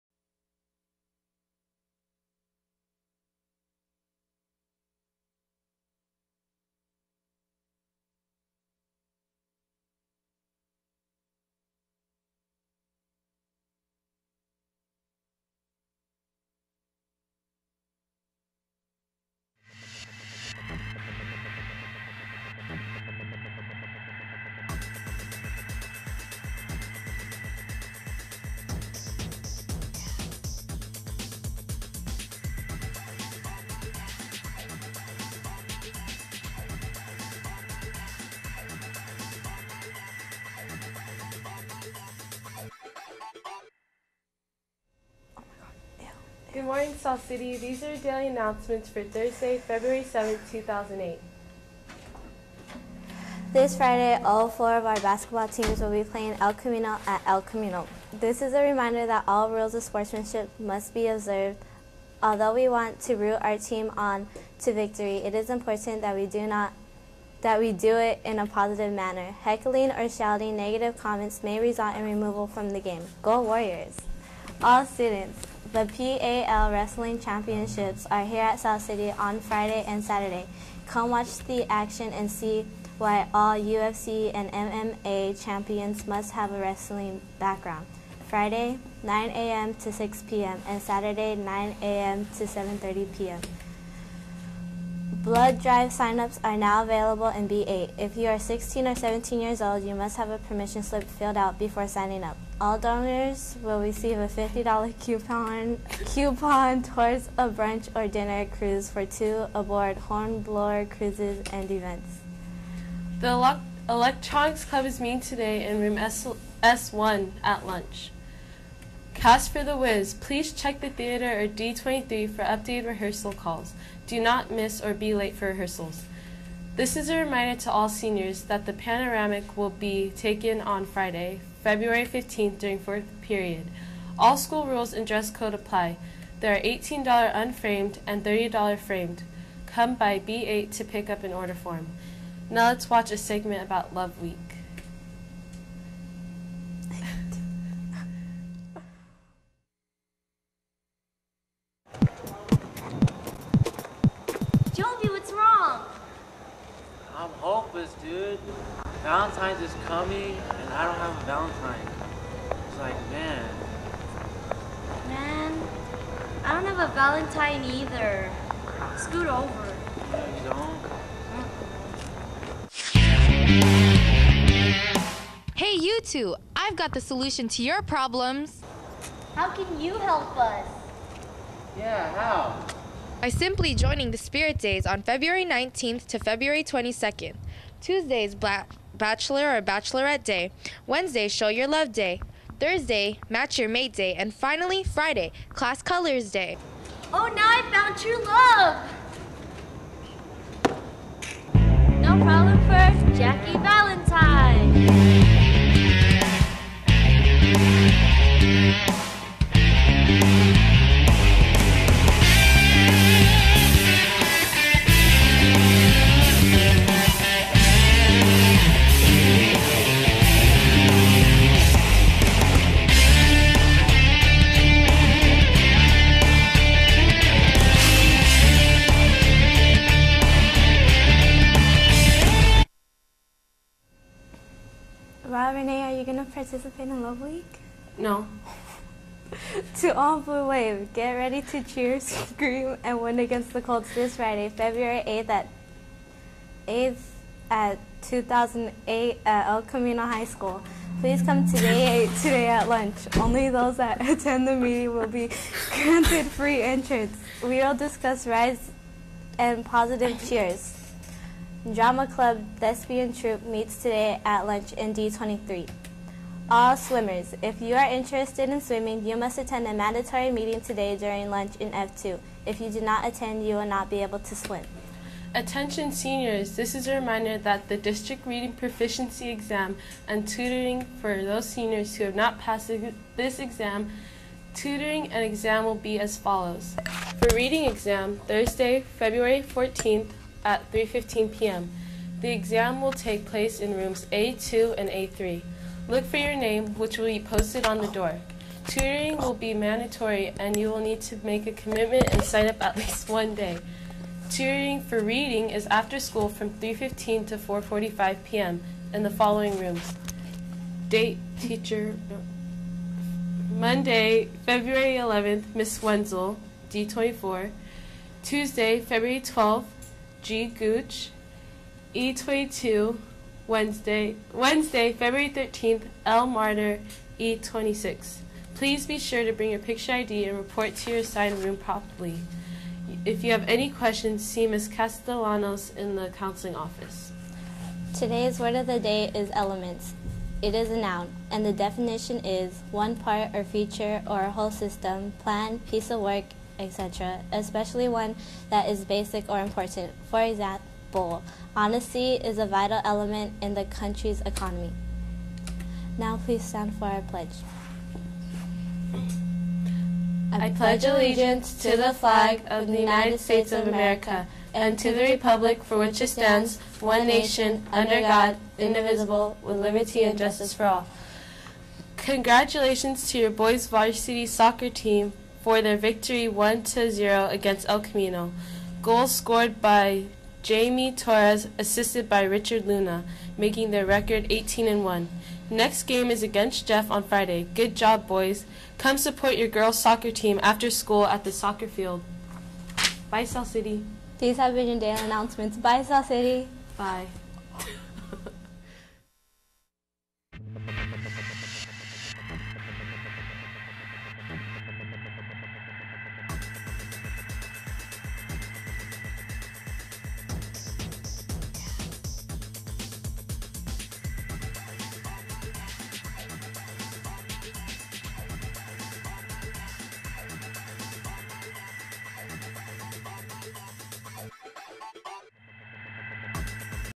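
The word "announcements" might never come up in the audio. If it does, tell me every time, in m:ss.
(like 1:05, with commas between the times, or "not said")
0:48, 6:35.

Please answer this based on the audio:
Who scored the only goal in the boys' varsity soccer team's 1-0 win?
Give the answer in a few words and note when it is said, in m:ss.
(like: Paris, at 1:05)
Jamie Torres, at 6:20.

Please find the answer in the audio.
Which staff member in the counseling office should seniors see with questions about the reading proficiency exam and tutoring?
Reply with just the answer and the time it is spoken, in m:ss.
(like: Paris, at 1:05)
Ms. Castellanos, at 5:34.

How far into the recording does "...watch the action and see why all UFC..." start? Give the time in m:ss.
1:21.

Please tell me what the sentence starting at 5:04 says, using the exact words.
Tutoring for reading is after school from 3:15 to 4:45 p.m.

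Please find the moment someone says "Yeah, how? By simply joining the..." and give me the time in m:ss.
3:01.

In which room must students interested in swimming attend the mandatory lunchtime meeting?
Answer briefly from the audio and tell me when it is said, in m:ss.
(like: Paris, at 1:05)
F2, at 4:31.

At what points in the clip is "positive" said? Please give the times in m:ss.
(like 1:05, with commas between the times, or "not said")
1:08, 4:19.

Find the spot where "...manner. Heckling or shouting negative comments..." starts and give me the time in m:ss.
1:08.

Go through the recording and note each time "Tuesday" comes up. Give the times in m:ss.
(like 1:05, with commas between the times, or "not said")
3:07, 5:18.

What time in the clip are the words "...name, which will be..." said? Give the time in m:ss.
4:56.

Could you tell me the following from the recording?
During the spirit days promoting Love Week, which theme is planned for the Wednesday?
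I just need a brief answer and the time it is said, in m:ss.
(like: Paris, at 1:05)
Show your love day, at 3:11.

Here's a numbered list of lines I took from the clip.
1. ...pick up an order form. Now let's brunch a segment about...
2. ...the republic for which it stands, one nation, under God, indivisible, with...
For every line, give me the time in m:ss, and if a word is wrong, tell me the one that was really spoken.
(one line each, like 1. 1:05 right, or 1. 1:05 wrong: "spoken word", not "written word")
1. 2:20 wrong: "watch", not "brunch"
2. 6:04 right.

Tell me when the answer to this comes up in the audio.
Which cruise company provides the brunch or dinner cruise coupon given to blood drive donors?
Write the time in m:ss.
1:49.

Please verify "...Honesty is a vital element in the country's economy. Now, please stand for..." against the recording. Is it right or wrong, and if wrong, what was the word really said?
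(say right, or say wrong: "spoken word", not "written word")
right.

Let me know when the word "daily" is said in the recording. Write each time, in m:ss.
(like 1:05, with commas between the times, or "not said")
0:47, 6:34.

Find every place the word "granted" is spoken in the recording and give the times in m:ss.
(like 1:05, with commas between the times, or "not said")
4:15.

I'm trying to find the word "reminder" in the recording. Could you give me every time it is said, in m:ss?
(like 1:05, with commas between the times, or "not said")
0:58, 2:07, 4:36.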